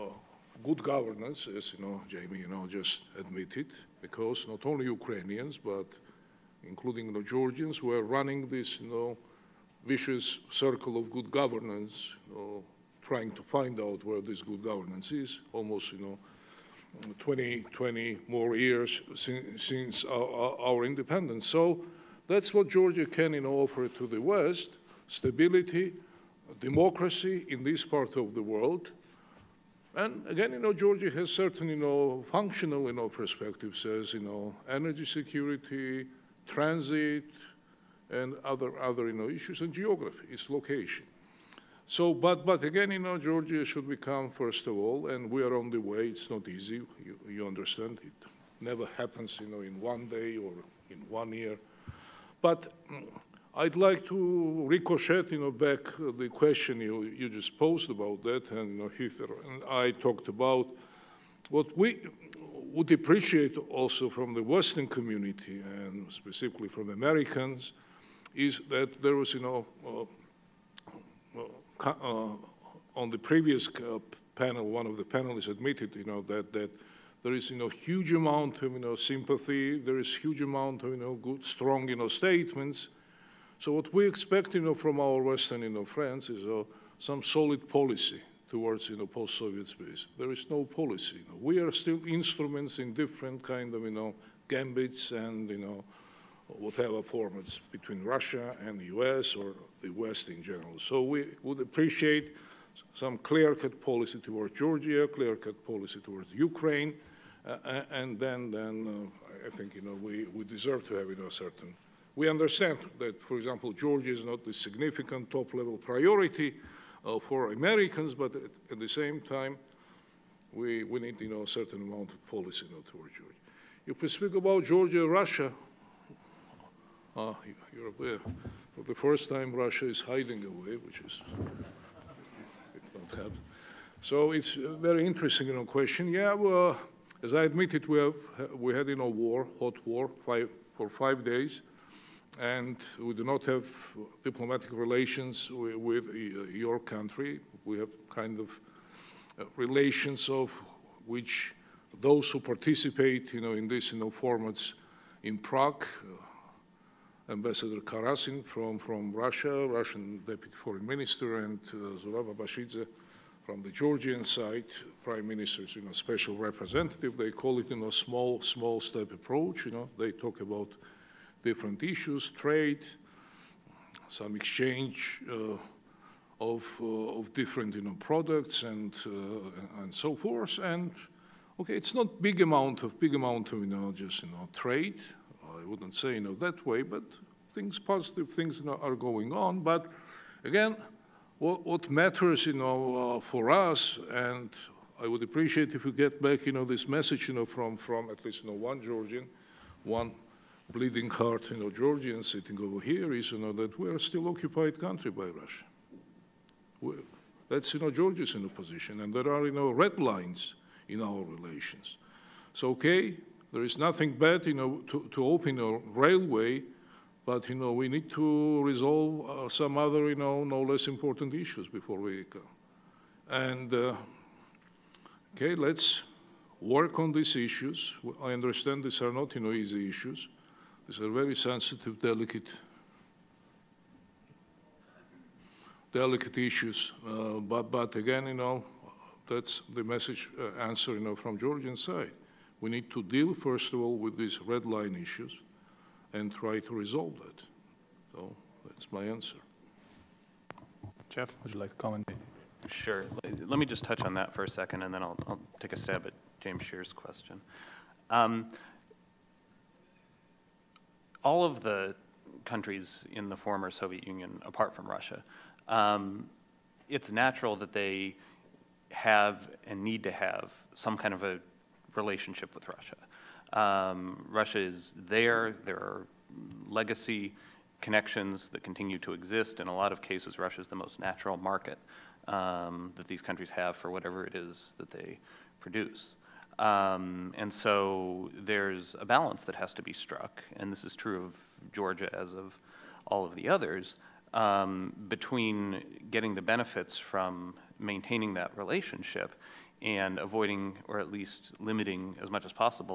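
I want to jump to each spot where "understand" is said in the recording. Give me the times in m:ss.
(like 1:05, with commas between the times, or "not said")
0:47, 1:52, 3:48.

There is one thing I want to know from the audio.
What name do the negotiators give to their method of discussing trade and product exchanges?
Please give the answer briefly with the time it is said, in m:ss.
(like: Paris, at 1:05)
small step approach, at 2:48.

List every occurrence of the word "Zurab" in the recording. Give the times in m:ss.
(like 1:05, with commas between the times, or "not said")
2:41.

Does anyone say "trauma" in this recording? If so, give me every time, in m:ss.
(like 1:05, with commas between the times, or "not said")
not said.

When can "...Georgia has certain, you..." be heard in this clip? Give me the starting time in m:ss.
0:30.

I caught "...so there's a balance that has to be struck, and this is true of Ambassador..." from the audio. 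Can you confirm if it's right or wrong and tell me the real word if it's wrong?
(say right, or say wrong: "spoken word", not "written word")
wrong: "Georgia", not "Ambassador".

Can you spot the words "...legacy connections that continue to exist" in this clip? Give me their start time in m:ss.
4:36.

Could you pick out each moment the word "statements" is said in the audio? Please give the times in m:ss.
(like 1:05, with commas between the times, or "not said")
1:22.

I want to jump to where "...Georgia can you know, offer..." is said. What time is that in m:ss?
0:22.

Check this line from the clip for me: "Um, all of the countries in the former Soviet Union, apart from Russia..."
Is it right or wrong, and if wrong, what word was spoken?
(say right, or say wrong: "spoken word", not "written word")
right.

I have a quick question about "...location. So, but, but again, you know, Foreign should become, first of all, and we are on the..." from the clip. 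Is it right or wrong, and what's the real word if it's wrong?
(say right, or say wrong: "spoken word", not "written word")
wrong: "Georgia", not "Foreign".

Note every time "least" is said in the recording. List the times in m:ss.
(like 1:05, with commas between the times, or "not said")
3:18, 5:01.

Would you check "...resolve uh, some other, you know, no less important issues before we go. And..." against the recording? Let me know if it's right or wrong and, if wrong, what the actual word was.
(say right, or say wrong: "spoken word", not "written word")
right.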